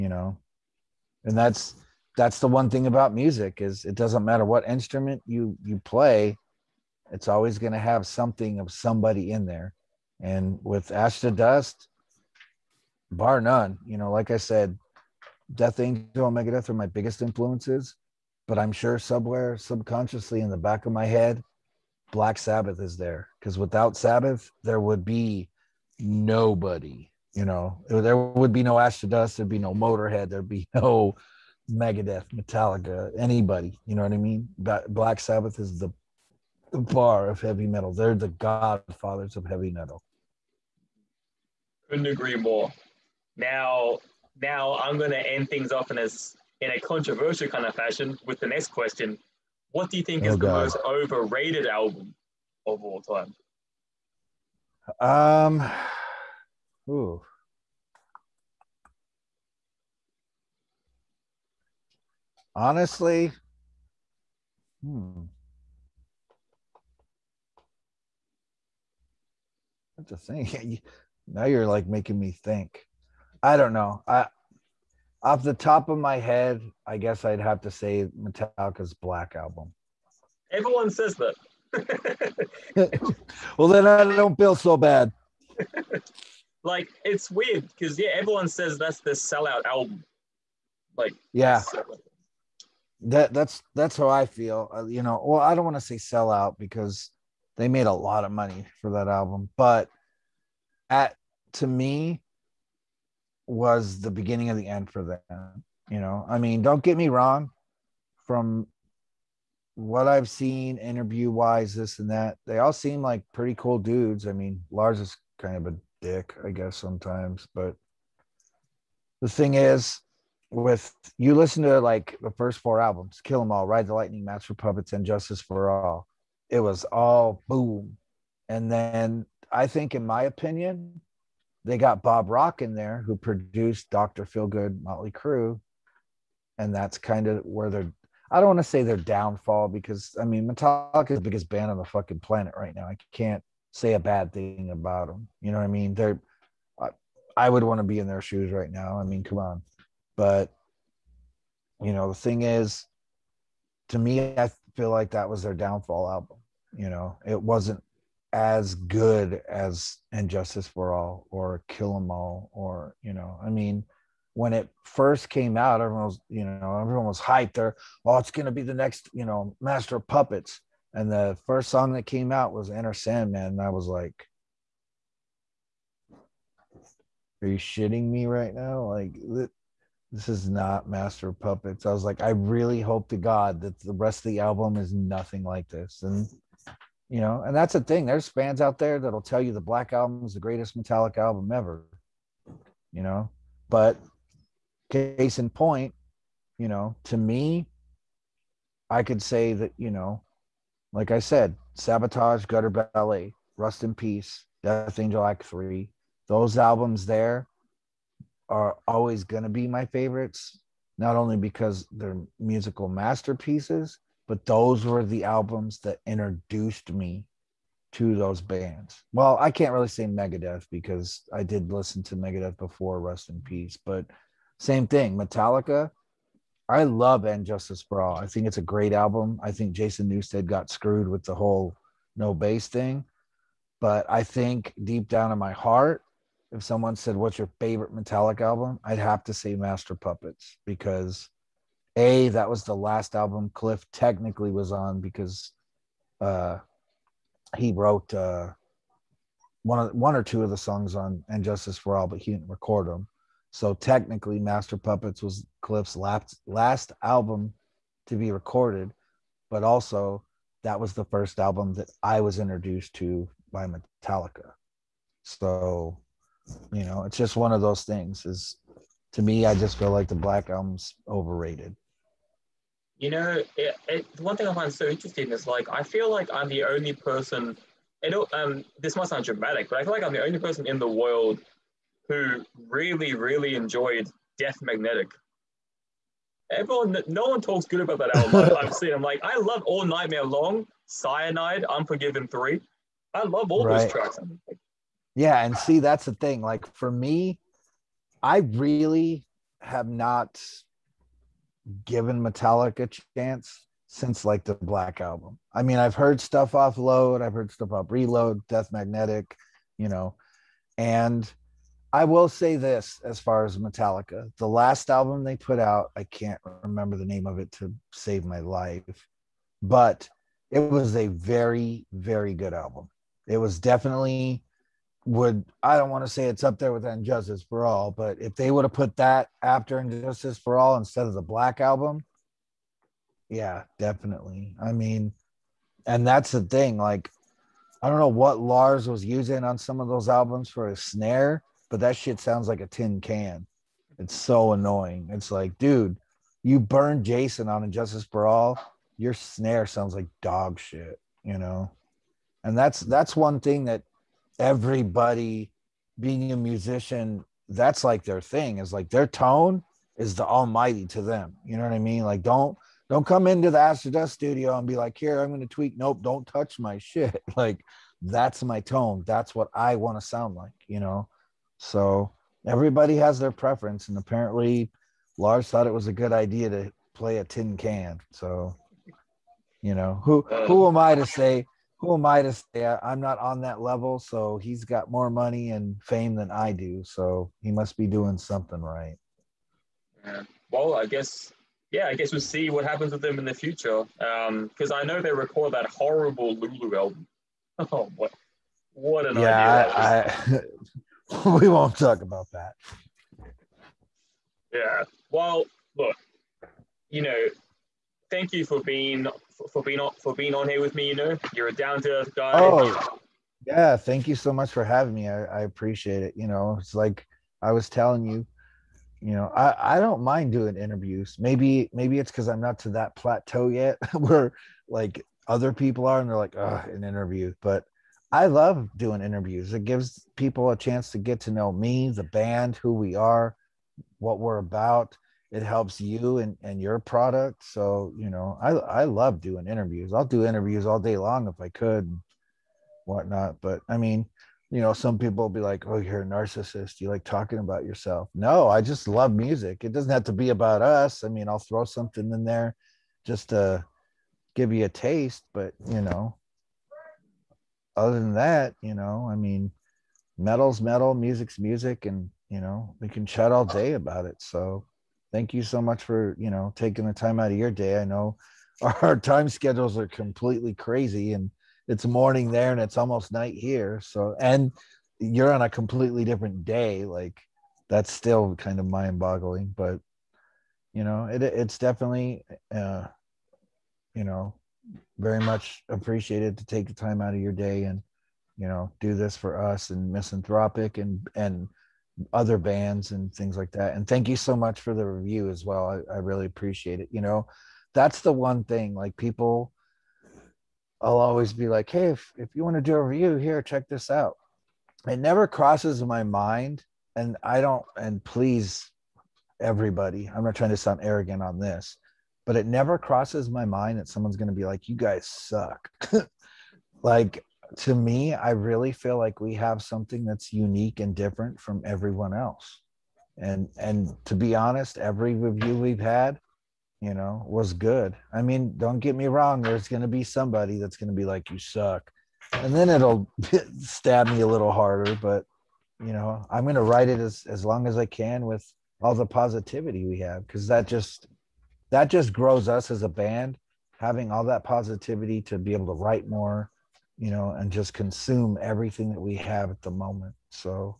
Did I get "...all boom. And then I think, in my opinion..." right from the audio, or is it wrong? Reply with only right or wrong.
right.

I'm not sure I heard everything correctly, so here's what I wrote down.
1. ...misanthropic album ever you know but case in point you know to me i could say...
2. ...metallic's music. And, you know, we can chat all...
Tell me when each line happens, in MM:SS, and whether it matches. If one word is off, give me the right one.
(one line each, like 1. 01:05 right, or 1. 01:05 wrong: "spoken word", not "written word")
1. 03:10 wrong: "metallic", not "misanthropic"
2. 07:40 wrong: "music", not "metallic".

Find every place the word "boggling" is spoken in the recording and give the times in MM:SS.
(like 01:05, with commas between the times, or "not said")
07:58.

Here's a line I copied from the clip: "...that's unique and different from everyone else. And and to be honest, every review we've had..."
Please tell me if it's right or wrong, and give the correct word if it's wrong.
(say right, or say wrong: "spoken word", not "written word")
right.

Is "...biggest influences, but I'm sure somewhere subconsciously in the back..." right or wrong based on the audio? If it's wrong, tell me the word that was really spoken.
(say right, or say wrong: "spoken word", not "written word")
right.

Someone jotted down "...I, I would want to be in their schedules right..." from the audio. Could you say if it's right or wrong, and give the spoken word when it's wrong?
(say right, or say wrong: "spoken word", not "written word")
wrong: "shoes", not "schedules".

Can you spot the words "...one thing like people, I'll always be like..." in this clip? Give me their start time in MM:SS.
08:18.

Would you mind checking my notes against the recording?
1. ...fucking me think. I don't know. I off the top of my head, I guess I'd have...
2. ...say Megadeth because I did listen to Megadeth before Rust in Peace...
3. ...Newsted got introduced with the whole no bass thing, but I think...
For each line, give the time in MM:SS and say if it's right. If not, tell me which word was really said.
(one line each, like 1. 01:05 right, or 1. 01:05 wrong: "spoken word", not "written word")
1. 01:11 wrong: "making", not "fucking"
2. 03:39 right
3. 03:50 wrong: "screwed", not "introduced".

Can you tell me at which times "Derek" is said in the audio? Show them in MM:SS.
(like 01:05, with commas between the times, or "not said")
not said.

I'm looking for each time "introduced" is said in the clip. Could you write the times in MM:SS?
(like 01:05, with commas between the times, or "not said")
03:36, 04:22.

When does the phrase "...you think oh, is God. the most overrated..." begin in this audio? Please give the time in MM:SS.
00:49.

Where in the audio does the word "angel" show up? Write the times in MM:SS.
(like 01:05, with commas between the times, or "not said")
00:15, 03:24.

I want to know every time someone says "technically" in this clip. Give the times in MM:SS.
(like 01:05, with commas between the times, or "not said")
04:03, 04:13.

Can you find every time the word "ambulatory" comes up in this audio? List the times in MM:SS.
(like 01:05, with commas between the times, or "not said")
not said.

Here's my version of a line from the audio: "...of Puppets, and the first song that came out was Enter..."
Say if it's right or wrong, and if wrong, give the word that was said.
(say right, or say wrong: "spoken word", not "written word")
right.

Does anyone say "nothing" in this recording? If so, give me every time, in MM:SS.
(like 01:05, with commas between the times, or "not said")
03:04.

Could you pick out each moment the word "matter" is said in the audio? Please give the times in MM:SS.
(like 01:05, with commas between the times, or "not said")
00:04.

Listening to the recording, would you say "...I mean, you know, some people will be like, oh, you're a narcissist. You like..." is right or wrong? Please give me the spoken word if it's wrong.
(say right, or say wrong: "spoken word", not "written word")
right.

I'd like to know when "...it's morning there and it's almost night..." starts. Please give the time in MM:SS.
07:51.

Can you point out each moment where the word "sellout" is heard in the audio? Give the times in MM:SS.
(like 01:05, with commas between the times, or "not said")
01:29, 01:35.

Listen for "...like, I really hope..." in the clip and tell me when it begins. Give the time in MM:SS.
03:02.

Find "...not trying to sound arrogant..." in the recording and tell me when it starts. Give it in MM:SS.
08:30.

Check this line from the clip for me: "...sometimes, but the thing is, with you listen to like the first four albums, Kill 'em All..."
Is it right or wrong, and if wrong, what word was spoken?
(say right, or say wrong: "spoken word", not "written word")
right.